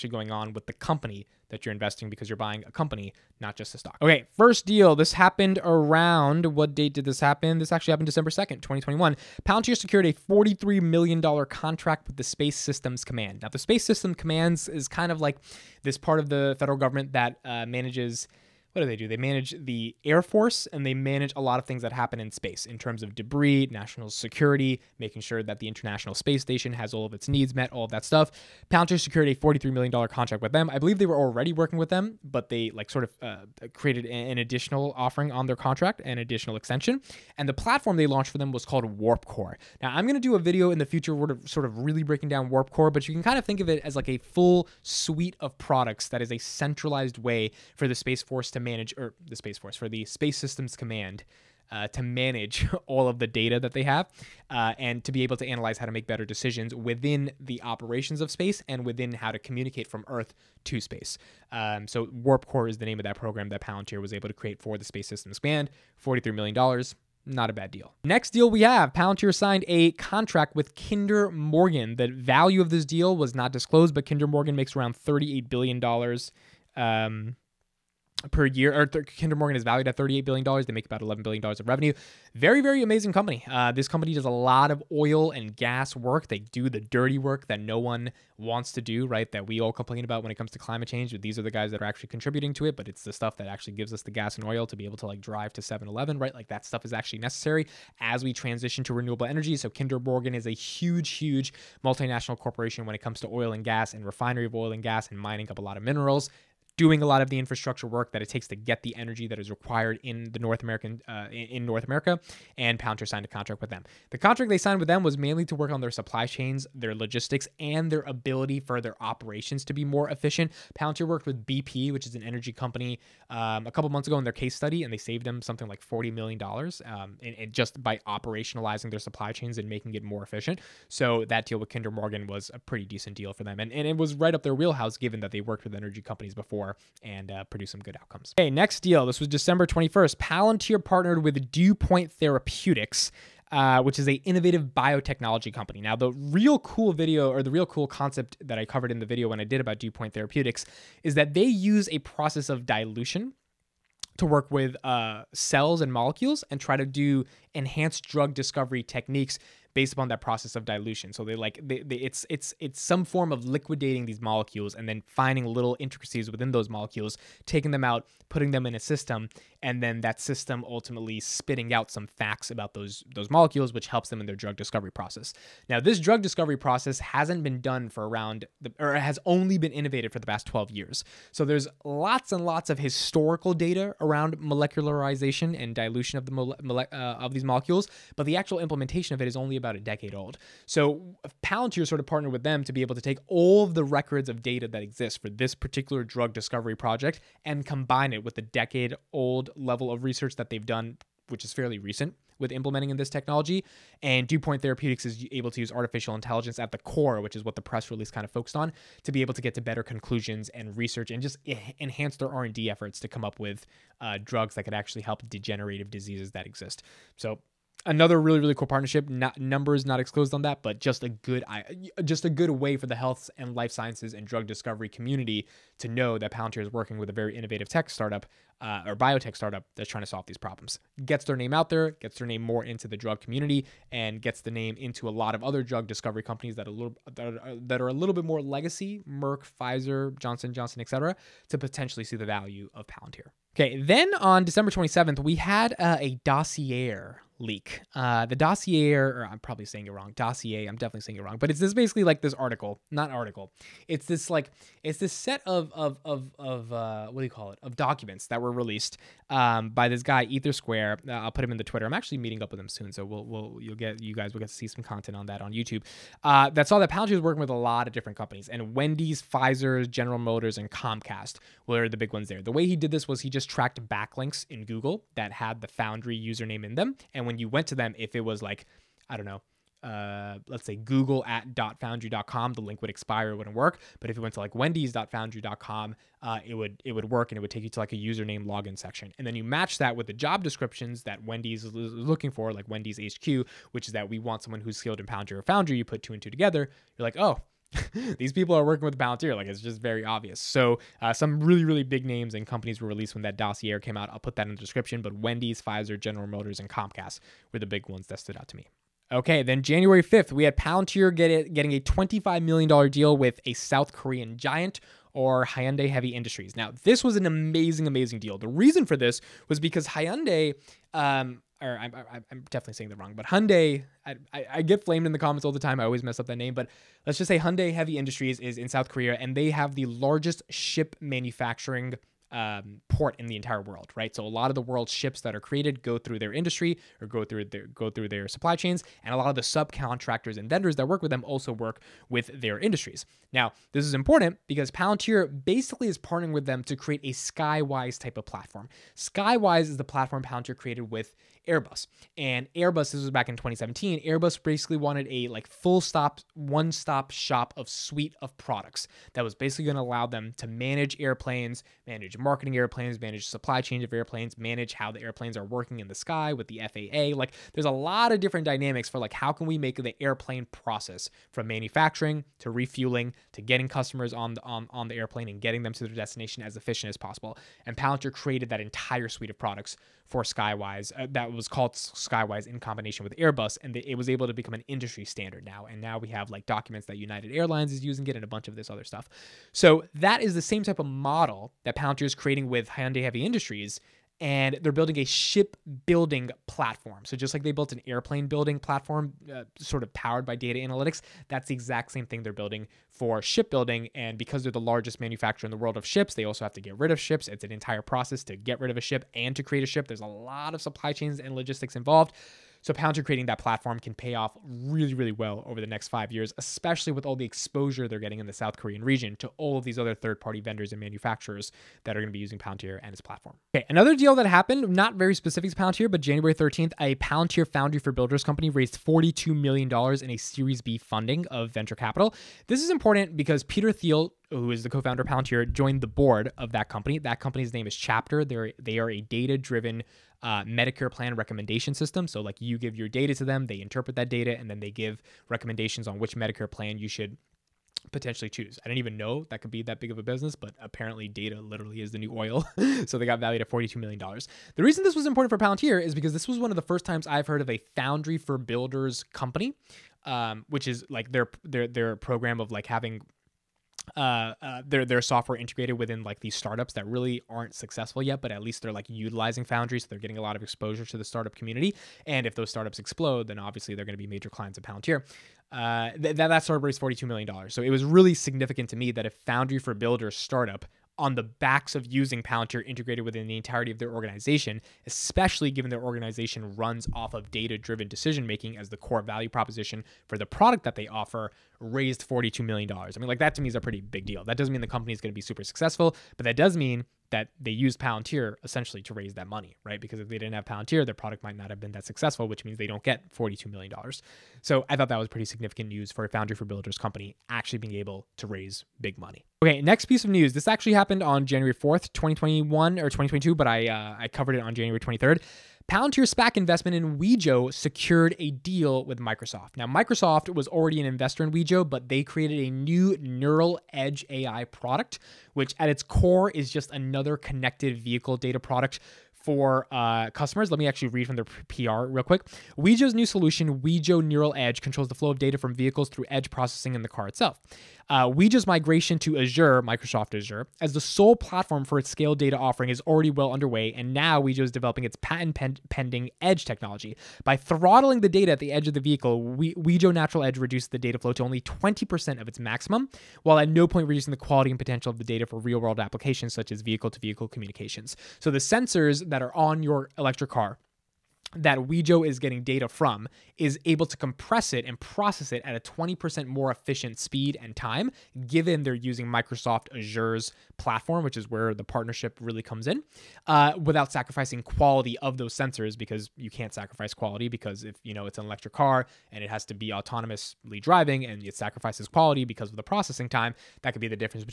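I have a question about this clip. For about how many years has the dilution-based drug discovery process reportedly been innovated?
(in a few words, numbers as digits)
12 years.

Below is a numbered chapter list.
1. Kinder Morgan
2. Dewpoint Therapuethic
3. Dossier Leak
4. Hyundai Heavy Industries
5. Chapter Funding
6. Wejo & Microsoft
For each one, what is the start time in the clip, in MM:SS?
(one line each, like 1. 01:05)
1. 01:08
2. 02:18
3. 04:03
4. 05:07
5. 07:02
6. 08:29.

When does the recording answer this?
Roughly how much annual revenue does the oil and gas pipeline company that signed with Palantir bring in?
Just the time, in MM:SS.
01:21.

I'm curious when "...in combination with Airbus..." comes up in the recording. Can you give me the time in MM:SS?
06:22.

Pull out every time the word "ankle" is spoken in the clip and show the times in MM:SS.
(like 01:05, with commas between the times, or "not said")
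not said.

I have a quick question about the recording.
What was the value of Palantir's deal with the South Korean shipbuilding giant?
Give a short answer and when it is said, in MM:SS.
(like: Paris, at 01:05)
$25 million, at 05:11.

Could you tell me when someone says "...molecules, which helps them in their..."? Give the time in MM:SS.
02:53.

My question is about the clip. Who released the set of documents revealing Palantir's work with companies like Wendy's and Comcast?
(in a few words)
EtherSquare.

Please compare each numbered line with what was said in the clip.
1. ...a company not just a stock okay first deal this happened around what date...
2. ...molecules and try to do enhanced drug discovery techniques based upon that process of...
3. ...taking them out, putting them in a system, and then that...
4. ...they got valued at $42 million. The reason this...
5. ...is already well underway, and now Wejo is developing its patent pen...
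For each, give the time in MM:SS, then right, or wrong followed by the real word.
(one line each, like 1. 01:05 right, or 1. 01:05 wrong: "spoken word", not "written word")
1. 00:02 right
2. 02:35 right
3. 02:47 right
4. 07:32 right
5. 09:02 right.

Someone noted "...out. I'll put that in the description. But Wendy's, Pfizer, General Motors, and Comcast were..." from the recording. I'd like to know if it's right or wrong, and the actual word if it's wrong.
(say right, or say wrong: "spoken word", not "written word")
right.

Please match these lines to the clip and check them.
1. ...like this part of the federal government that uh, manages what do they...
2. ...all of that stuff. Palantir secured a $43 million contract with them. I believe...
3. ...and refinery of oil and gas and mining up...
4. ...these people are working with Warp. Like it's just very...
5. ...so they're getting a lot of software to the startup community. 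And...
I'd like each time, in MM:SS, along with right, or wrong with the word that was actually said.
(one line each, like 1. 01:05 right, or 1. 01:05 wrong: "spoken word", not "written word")
1. 00:15 right
2. 00:27 right
3. 01:43 right
4. 04:58 wrong: "Palantir", not "Warp"
5. 07:49 wrong: "exposure", not "software".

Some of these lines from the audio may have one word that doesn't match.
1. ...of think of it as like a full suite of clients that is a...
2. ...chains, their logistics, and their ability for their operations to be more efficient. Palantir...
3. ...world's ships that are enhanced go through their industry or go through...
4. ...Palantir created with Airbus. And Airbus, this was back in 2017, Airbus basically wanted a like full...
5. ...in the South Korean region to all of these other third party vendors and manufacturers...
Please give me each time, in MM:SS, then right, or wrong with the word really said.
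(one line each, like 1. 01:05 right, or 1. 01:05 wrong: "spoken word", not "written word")
1. 00:43 wrong: "products", not "clients"
2. 01:56 right
3. 05:34 wrong: "created", not "enhanced"
4. 05:50 right
5. 06:58 right.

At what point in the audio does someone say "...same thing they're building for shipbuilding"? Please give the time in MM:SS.
06:41.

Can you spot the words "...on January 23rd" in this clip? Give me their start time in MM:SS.
08:34.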